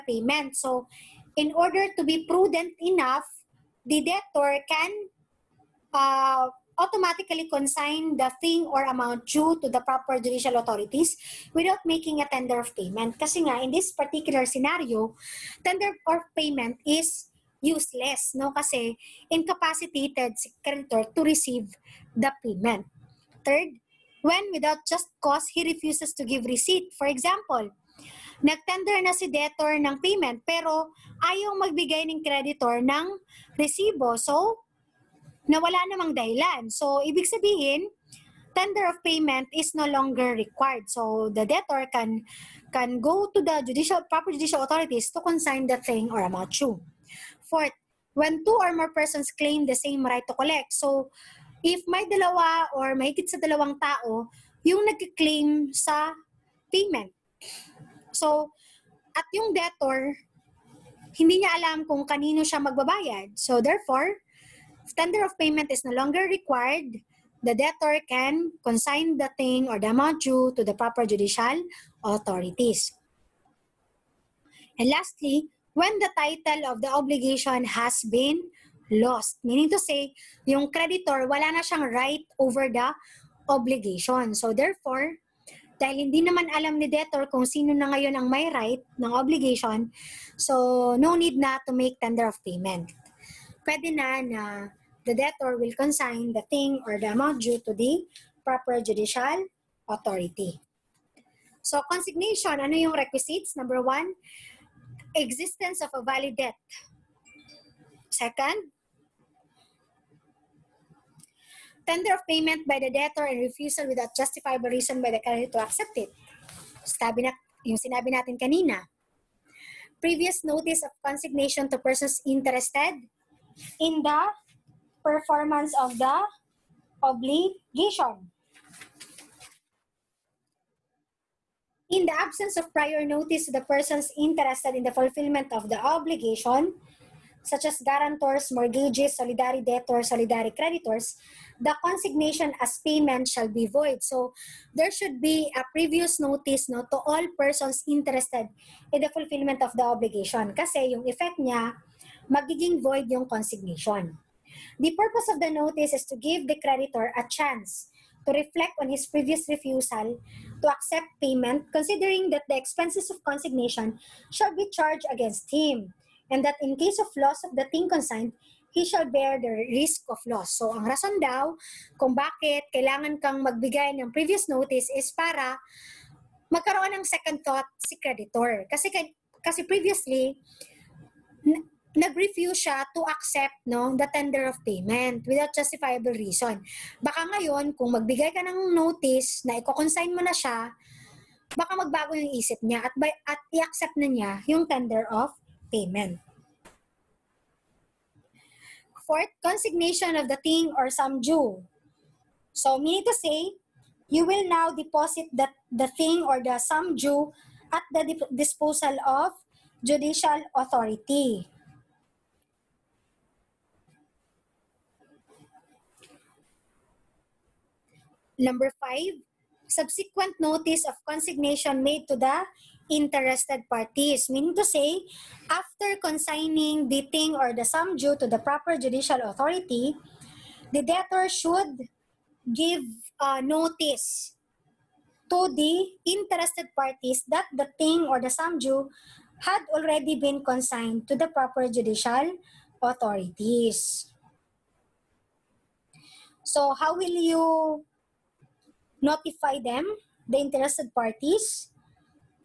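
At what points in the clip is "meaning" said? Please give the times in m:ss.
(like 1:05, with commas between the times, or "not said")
1:19, 3:22, 3:44.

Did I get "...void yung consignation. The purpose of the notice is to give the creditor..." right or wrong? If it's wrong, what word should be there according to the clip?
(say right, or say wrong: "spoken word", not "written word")
right.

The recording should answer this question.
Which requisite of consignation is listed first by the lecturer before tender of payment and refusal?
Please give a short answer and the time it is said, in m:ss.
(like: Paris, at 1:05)
Existence of a valid debt, at 1:45.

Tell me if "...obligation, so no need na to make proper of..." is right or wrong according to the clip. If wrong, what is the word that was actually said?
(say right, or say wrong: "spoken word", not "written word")
wrong: "tender", not "proper".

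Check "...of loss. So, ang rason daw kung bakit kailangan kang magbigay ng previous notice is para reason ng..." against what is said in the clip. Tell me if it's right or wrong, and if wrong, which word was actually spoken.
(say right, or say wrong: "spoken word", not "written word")
wrong: "magkaroon", not "reason".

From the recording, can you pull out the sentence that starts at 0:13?
Kasi nga, in this particular scenario, tender of payment is useless, no?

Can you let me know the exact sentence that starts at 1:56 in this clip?
Sabi na, yung sinabi natin kanina.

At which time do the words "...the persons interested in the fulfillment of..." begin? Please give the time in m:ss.
2:13.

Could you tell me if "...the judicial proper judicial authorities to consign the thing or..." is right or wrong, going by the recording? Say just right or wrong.
right.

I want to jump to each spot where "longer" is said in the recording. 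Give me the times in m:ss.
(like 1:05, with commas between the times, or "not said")
0:39, 1:05.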